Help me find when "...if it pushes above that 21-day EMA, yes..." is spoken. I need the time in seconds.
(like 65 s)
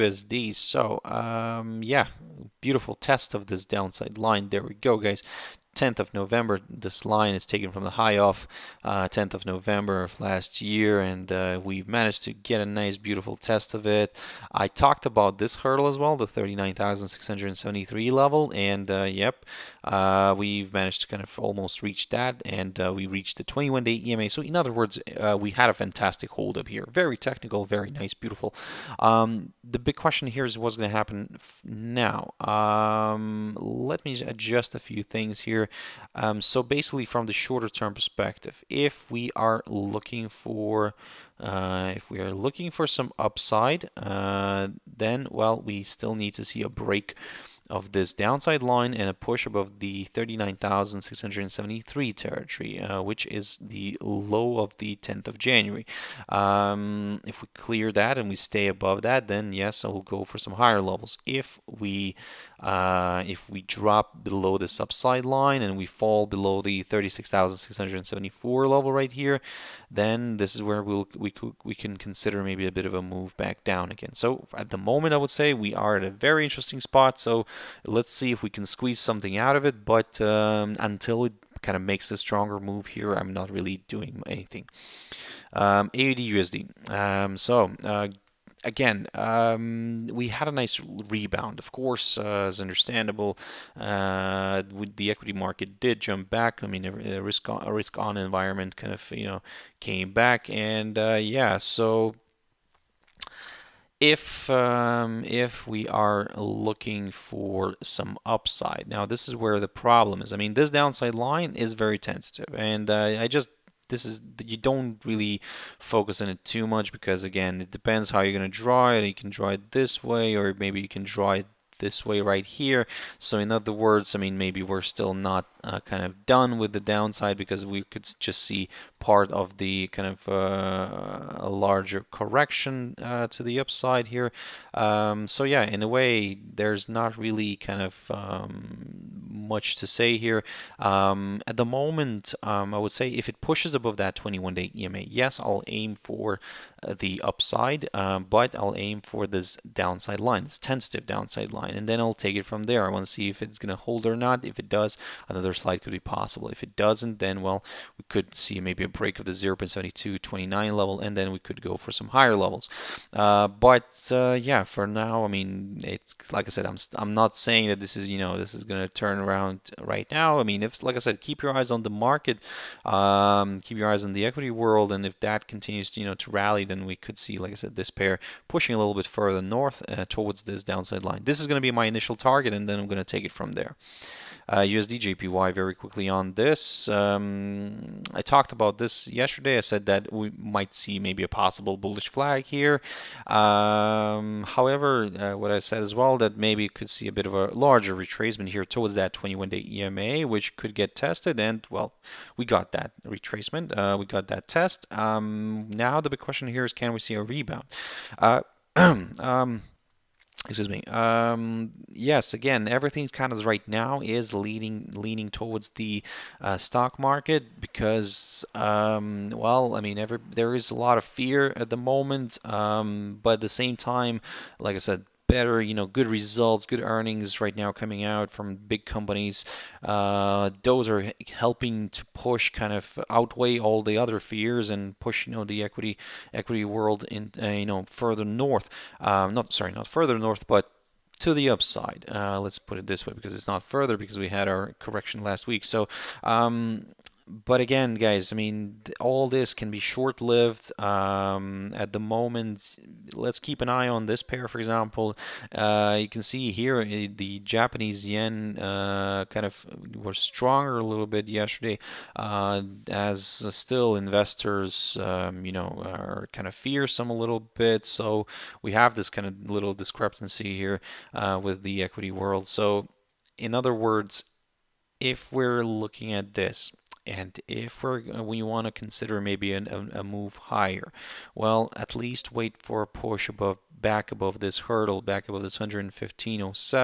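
143 s.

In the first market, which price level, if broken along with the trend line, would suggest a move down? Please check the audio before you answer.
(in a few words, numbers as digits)
36,674.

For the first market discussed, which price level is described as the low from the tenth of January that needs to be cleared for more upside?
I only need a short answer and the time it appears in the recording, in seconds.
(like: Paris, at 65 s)
39,673, at 50 s.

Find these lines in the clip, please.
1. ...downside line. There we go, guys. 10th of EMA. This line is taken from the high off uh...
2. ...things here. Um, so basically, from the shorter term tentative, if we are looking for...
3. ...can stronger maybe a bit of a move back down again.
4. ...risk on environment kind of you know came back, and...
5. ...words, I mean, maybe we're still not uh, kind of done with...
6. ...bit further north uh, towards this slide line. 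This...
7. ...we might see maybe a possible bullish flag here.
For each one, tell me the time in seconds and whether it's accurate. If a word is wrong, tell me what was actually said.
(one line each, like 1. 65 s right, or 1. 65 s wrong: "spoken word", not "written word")
1. 3 s wrong: "November", not "EMA"
2. 35 s wrong: "perspective", not "tentative"
3. 71 s wrong: "consider", not "stronger"
4. 97 s right
5. 123 s right
6. 178 s wrong: "downside", not "slide"
7. 190 s right.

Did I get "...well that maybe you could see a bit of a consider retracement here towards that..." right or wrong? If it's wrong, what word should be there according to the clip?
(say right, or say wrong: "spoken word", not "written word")
wrong: "larger", not "consider".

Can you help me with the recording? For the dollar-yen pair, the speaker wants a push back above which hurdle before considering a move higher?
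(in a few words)
115.07.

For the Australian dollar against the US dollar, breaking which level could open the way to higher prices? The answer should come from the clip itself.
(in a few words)
0.7229.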